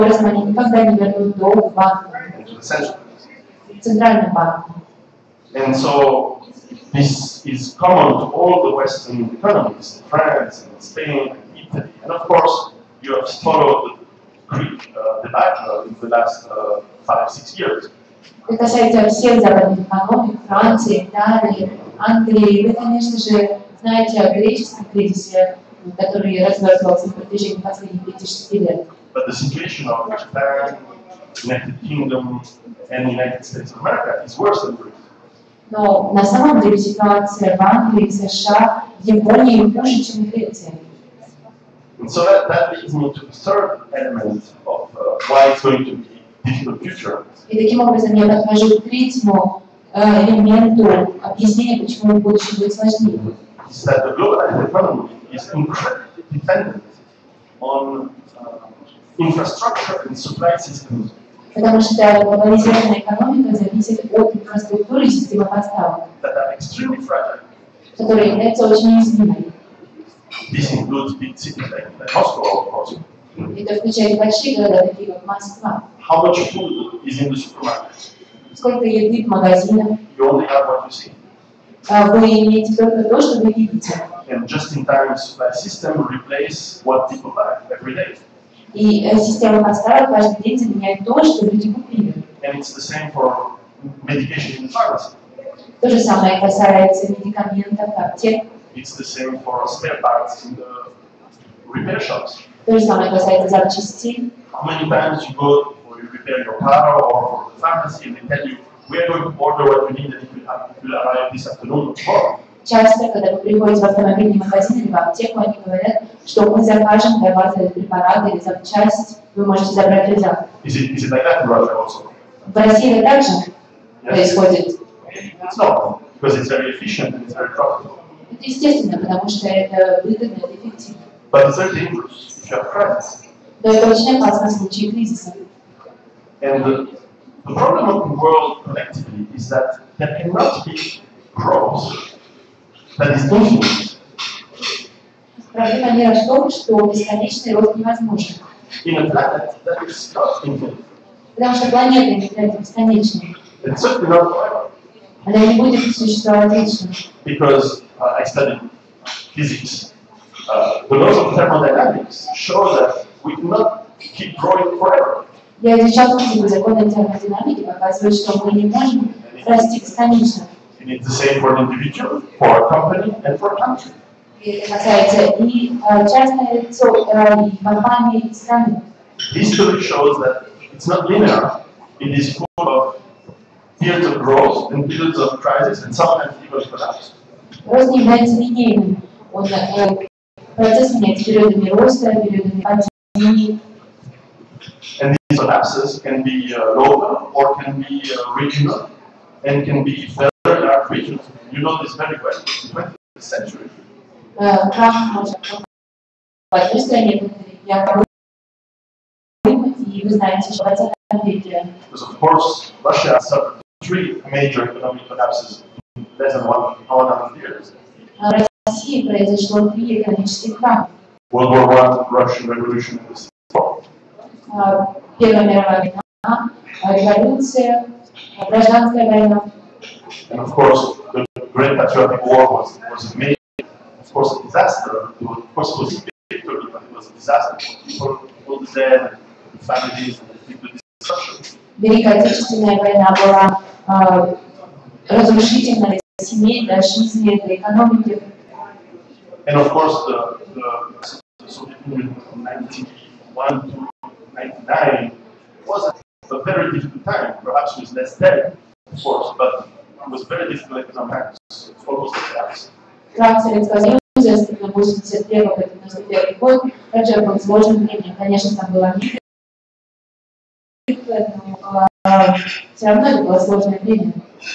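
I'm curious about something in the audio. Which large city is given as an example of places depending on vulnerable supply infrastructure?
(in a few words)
Moscow.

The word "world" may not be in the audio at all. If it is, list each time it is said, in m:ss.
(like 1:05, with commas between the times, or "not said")
2:18, 3:41.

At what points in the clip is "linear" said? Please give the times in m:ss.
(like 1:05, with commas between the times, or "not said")
3:01.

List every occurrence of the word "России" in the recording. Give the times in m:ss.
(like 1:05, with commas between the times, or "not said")
2:02, 3:38.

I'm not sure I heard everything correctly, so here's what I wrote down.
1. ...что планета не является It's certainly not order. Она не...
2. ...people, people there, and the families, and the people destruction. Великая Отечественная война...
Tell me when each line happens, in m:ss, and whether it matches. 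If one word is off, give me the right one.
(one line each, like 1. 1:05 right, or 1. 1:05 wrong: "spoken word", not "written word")
1. 2:31 wrong: "forever", not "order"
2. 3:58 right.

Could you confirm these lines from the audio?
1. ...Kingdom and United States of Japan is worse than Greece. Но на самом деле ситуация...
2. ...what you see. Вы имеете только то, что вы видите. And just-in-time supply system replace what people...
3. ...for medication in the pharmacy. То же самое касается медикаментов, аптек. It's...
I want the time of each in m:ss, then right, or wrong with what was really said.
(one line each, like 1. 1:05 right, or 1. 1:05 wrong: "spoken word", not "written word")
1. 0:31 wrong: "America", not "Japan"
2. 1:20 right
3. 1:33 right.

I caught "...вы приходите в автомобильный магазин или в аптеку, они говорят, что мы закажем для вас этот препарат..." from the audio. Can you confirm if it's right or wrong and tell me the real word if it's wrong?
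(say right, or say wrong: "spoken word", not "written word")
right.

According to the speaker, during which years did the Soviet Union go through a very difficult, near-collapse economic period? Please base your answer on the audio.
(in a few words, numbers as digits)
1991 to 1999.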